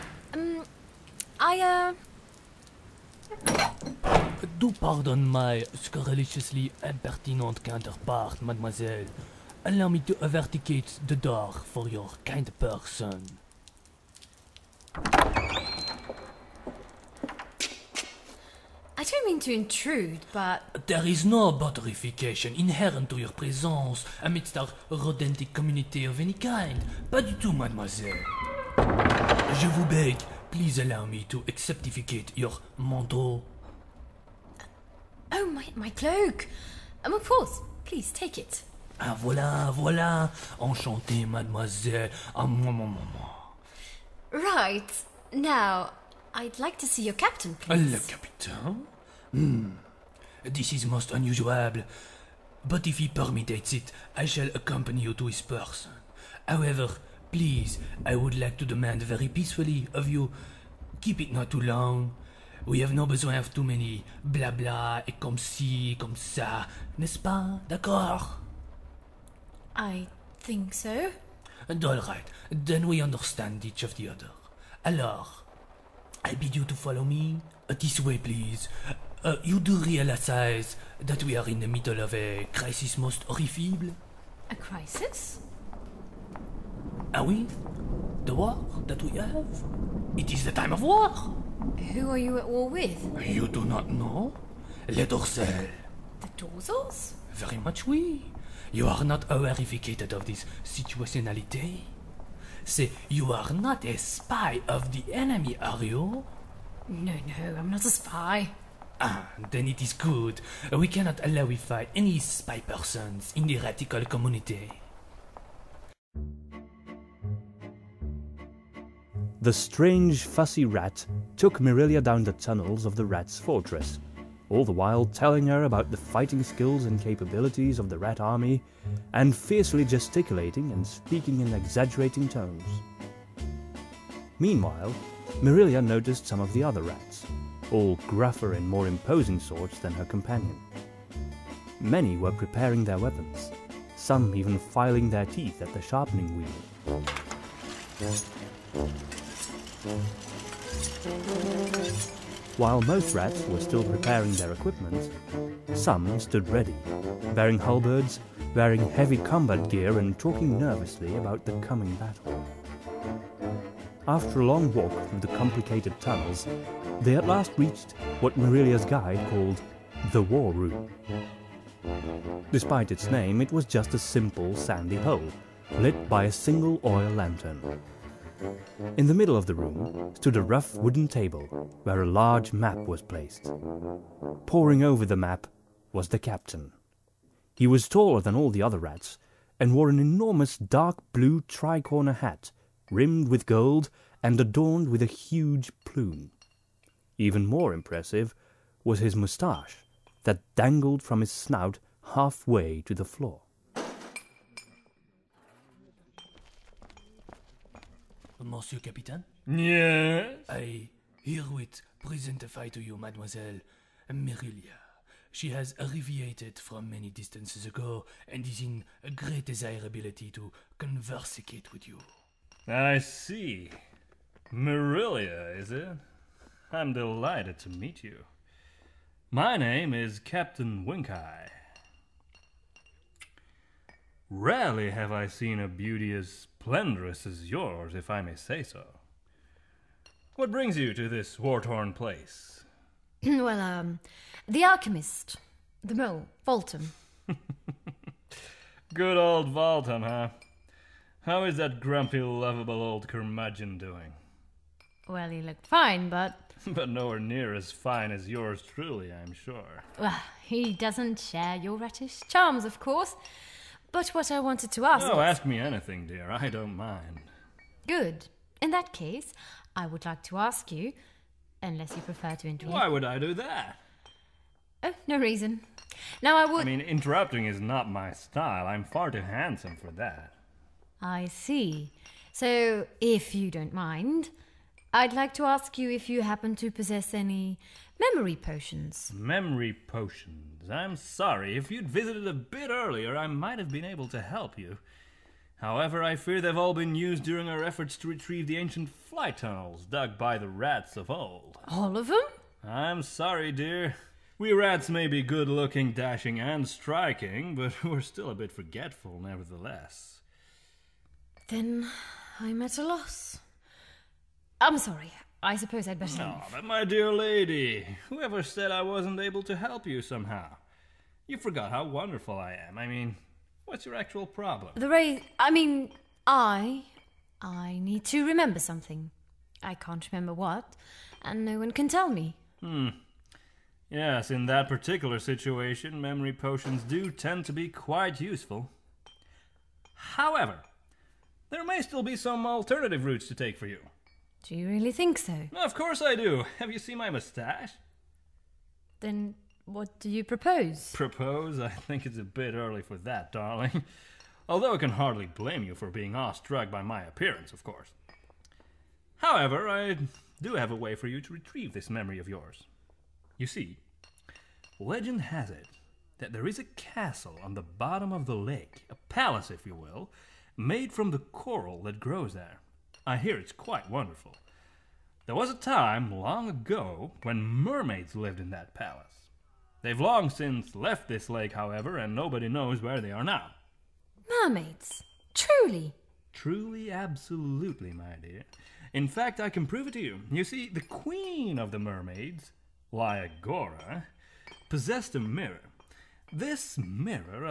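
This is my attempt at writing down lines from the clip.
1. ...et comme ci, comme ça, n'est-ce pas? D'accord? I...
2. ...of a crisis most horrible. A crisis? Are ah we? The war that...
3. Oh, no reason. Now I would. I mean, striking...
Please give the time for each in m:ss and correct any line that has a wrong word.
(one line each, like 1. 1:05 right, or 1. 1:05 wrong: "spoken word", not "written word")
1. 1:05 right
2. 1:22 right
3. 4:34 wrong: "interrupting", not "striking".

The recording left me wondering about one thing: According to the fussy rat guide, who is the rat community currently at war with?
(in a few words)
The Dorsals.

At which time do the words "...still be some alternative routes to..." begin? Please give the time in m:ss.
5:41.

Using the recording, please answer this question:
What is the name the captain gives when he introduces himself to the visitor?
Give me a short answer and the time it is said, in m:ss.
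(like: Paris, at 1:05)
Captain Winkeye, at 3:50.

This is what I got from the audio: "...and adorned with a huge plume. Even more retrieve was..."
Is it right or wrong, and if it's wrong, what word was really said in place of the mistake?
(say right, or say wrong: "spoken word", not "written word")
wrong: "impressive", not "retrieve".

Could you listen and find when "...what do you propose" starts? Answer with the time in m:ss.
5:49.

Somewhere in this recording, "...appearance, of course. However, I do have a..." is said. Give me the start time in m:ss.
5:57.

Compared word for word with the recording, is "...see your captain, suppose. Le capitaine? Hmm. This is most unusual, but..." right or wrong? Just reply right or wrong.
wrong.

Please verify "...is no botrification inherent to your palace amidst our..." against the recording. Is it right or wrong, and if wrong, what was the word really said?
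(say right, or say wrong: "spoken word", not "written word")
wrong: "presence", not "palace".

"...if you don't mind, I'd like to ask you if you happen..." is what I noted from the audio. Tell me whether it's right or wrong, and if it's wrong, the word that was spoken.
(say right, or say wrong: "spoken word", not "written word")
right.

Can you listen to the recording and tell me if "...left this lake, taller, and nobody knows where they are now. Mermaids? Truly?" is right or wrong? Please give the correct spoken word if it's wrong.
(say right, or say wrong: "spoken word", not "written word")
wrong: "however", not "taller".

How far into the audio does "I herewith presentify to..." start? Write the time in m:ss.
3:30.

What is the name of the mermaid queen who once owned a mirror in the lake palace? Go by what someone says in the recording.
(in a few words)
Lyagora.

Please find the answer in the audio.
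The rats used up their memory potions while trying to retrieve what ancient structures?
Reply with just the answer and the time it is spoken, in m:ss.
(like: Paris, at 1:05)
Fly tunnels, at 4:58.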